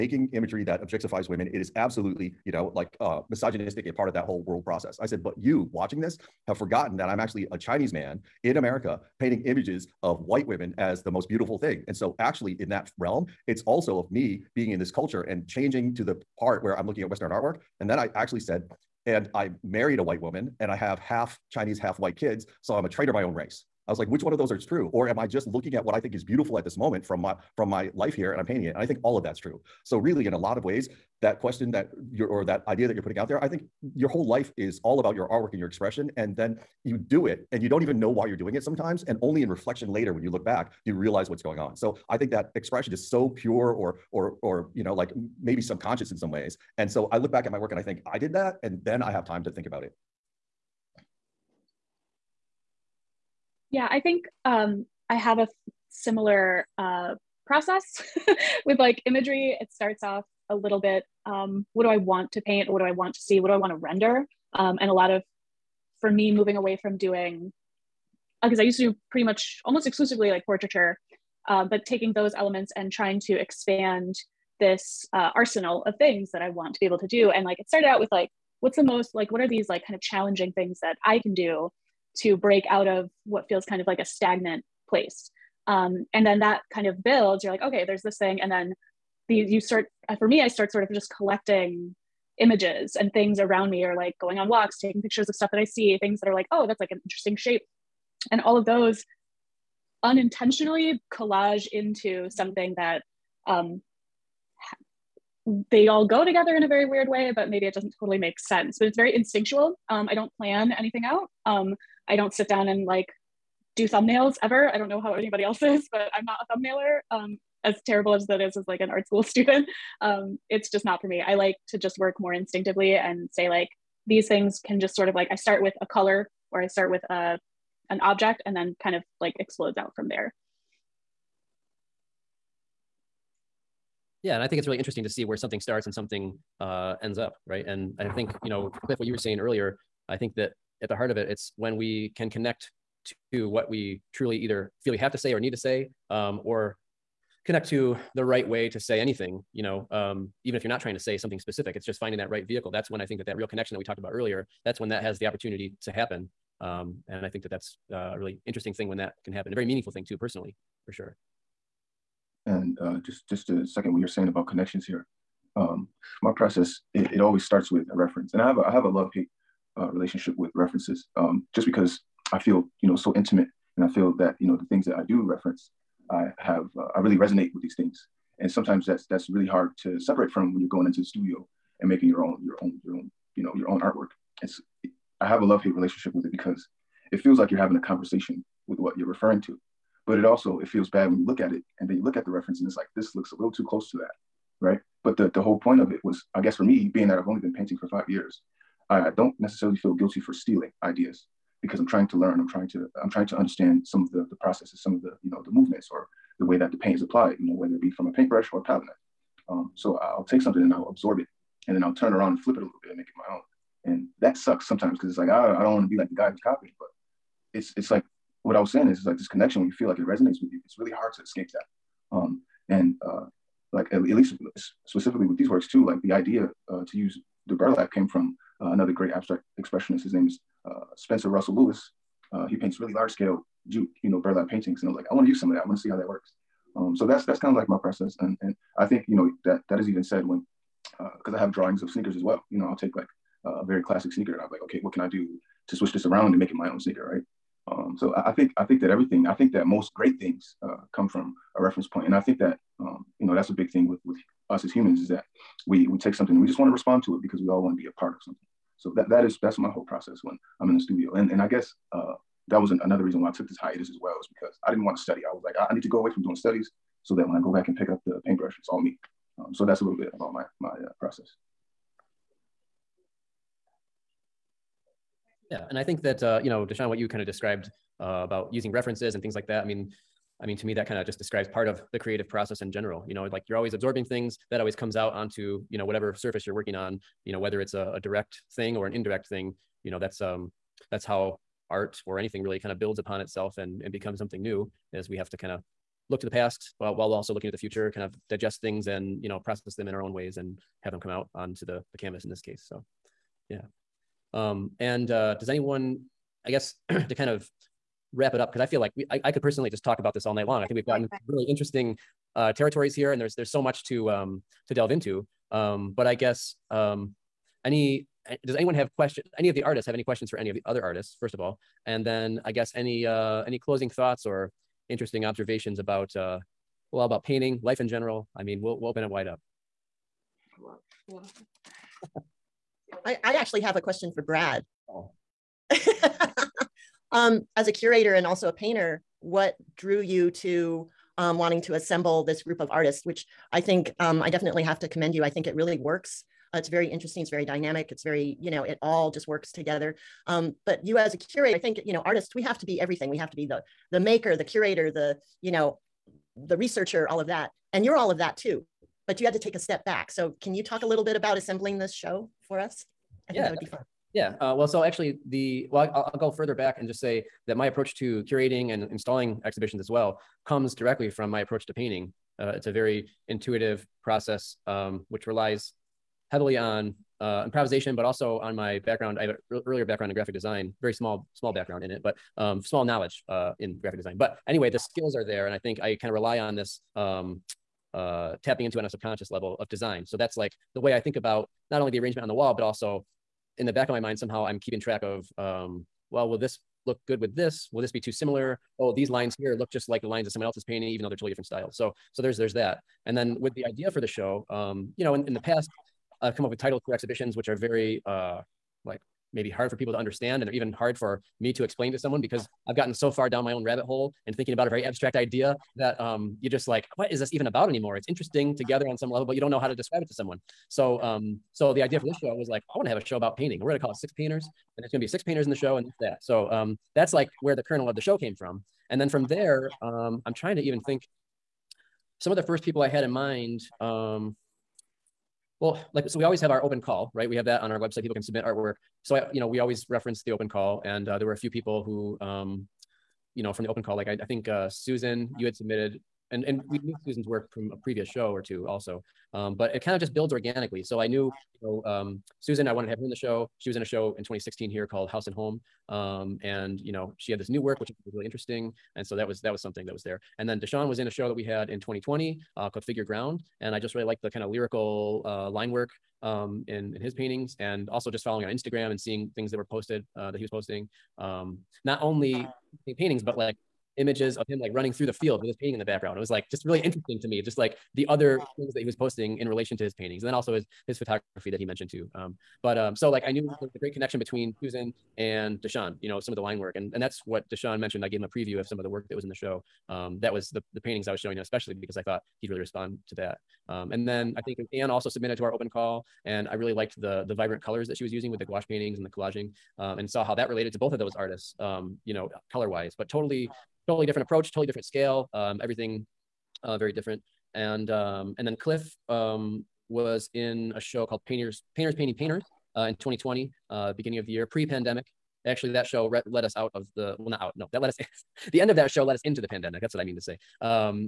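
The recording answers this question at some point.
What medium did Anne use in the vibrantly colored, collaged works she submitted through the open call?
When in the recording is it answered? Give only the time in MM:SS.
08:18.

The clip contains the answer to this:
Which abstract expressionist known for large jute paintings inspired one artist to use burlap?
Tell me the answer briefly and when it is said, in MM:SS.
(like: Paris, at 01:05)
Spencer Russell Lewis, at 03:50.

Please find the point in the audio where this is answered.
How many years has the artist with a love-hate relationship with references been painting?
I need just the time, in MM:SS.
03:17.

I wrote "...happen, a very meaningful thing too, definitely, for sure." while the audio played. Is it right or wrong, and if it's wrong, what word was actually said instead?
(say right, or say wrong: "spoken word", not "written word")
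wrong: "personally", not "definitely".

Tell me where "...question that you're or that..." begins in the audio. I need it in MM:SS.
00:31.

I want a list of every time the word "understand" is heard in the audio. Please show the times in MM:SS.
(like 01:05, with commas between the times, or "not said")
03:23, 06:49.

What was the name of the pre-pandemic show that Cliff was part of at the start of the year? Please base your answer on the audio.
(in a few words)
Painters Painting Painters.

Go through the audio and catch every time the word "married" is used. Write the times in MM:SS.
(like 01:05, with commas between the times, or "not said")
00:19.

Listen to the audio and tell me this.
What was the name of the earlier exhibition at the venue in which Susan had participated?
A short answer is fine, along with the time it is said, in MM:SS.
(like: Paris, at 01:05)
House and Home, at 07:35.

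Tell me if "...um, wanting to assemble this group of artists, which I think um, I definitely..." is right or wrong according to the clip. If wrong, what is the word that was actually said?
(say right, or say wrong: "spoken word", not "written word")
right.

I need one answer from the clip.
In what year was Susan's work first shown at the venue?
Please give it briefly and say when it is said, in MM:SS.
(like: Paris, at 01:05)
2016, at 07:34.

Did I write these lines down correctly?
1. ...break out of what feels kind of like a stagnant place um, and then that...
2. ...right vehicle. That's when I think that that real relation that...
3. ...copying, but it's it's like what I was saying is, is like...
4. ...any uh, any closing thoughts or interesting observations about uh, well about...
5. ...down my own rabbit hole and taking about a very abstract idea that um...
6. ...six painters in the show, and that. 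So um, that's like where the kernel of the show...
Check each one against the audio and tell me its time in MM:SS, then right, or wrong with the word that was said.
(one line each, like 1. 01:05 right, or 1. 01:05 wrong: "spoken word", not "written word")
1. 01:22 right
2. 02:32 wrong: "connection", not "relation"
3. 03:36 right
4. 05:22 right
5. 06:53 wrong: "thinking", not "taking"
6. 07:05 right.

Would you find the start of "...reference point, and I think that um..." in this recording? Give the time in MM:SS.
04:11.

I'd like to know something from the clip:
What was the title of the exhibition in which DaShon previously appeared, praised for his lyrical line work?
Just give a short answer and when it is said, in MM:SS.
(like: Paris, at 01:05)
Figure Ground, at 07:42.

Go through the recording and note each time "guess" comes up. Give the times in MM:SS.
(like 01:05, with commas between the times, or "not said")
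03:16, 04:21, 05:06, 05:16, 05:22.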